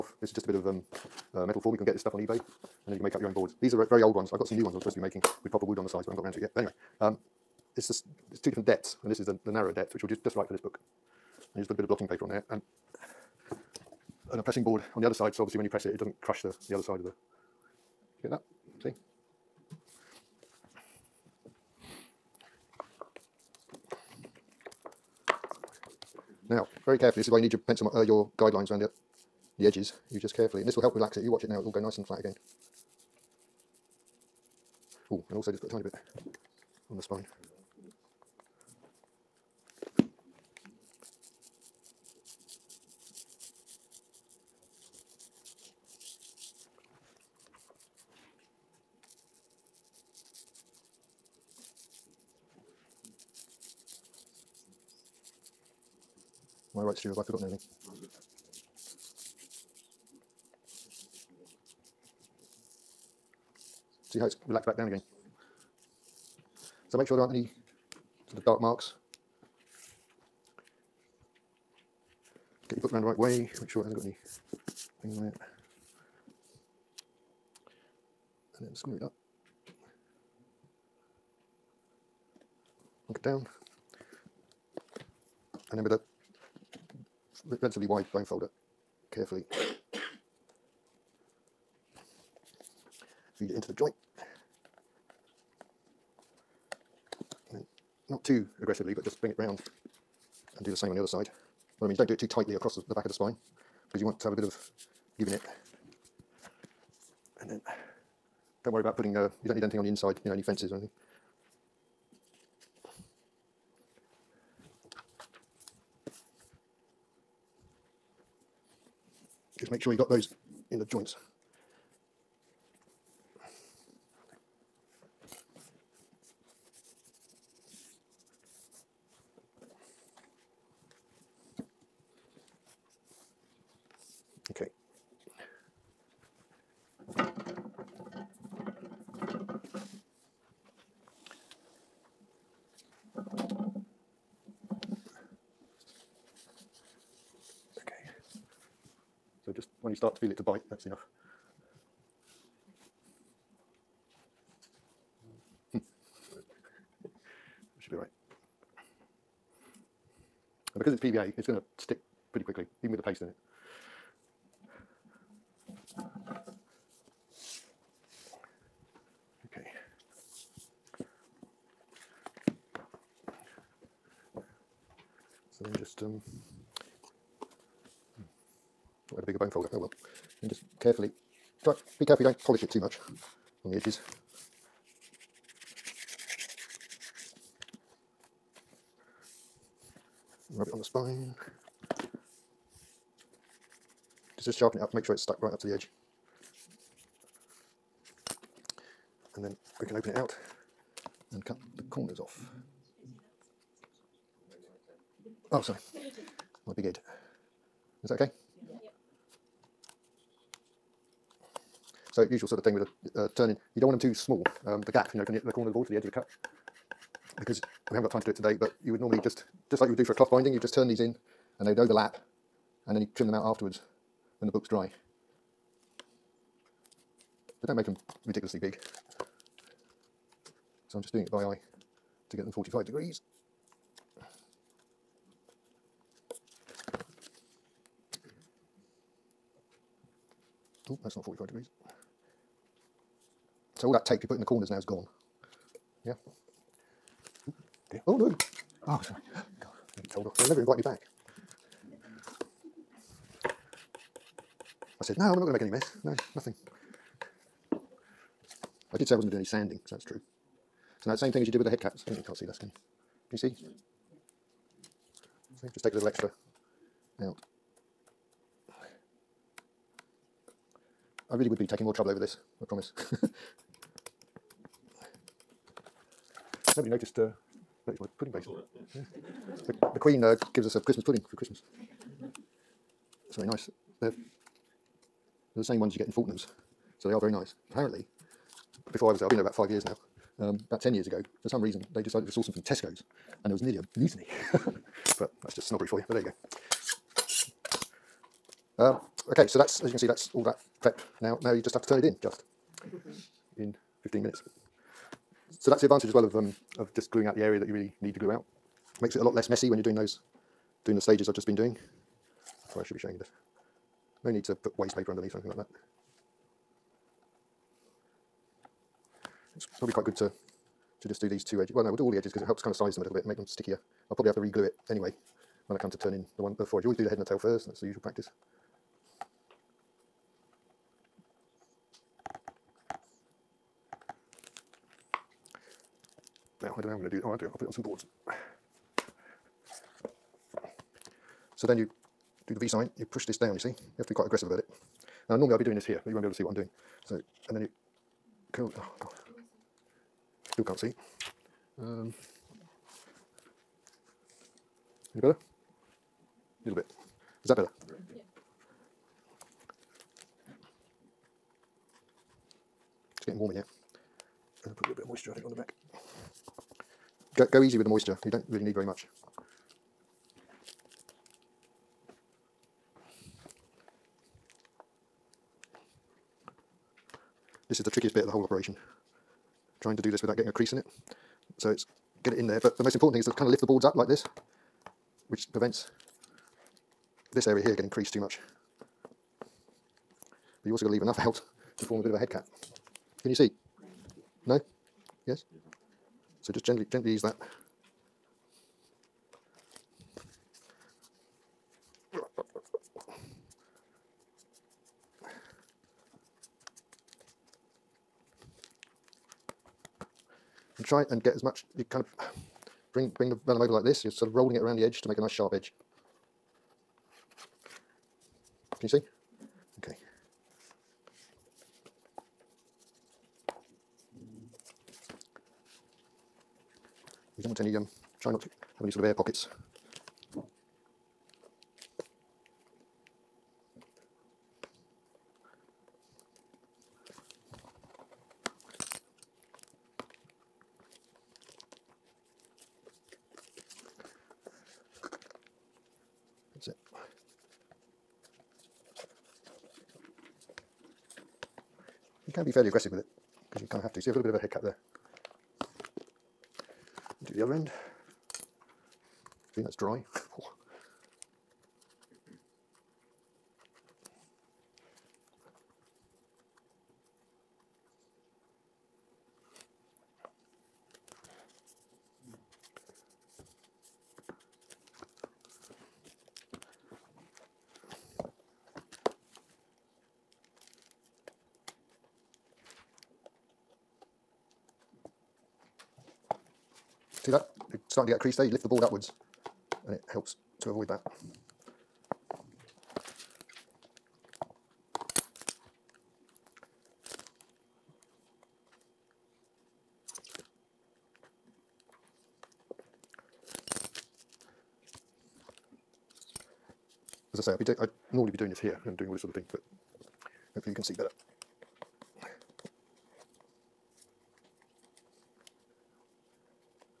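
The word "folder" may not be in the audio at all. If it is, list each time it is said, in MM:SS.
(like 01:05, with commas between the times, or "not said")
01:28, 02:59.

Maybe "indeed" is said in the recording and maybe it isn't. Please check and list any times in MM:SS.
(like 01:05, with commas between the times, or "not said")
not said.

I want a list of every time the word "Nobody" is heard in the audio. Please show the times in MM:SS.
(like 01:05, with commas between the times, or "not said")
04:36.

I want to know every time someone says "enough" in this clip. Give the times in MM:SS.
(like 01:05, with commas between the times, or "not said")
02:30, 06:31.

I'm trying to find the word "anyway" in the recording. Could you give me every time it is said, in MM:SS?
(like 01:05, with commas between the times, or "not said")
00:06, 05:24.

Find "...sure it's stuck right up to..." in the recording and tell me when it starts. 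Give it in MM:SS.
03:15.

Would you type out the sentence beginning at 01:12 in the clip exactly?
Get your book round the right way, make sure it hasn't got any things on it.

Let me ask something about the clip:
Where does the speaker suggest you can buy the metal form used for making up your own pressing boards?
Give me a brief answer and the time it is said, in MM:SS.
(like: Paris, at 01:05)
eBay, at 00:02.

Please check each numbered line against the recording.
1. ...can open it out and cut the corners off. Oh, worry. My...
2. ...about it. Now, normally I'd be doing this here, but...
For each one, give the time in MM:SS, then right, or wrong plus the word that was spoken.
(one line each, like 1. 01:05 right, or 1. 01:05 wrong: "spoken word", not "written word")
1. 03:19 wrong: "sorry", not "worry"
2. 05:44 right.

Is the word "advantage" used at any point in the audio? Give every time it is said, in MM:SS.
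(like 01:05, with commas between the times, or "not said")
05:05.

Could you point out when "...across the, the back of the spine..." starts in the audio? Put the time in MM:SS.
01:42.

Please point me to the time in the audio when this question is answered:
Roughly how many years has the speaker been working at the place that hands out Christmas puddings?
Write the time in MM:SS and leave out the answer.
04:49.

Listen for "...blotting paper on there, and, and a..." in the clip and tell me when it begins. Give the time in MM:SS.
00:11.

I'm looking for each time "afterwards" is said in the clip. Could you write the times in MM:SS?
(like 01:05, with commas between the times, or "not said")
03:43.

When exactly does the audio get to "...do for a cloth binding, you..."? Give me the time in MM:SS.
03:39.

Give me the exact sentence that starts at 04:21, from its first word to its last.
So now the same thing as you did with the head caps.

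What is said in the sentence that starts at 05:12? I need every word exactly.
Sorry, I should be showing you this.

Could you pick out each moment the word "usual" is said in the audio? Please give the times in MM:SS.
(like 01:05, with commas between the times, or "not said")
03:32, 05:27.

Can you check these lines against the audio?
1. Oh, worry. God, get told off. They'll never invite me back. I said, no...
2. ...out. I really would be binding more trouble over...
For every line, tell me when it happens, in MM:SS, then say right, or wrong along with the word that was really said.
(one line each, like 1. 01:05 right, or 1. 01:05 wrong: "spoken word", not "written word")
1. 04:08 wrong: "sorry", not "worry"
2. 04:27 wrong: "taking", not "binding".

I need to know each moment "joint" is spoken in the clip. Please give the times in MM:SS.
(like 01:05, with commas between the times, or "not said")
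01:33, 02:00.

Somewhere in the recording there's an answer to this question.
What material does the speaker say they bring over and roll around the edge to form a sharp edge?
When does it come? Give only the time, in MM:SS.
06:53.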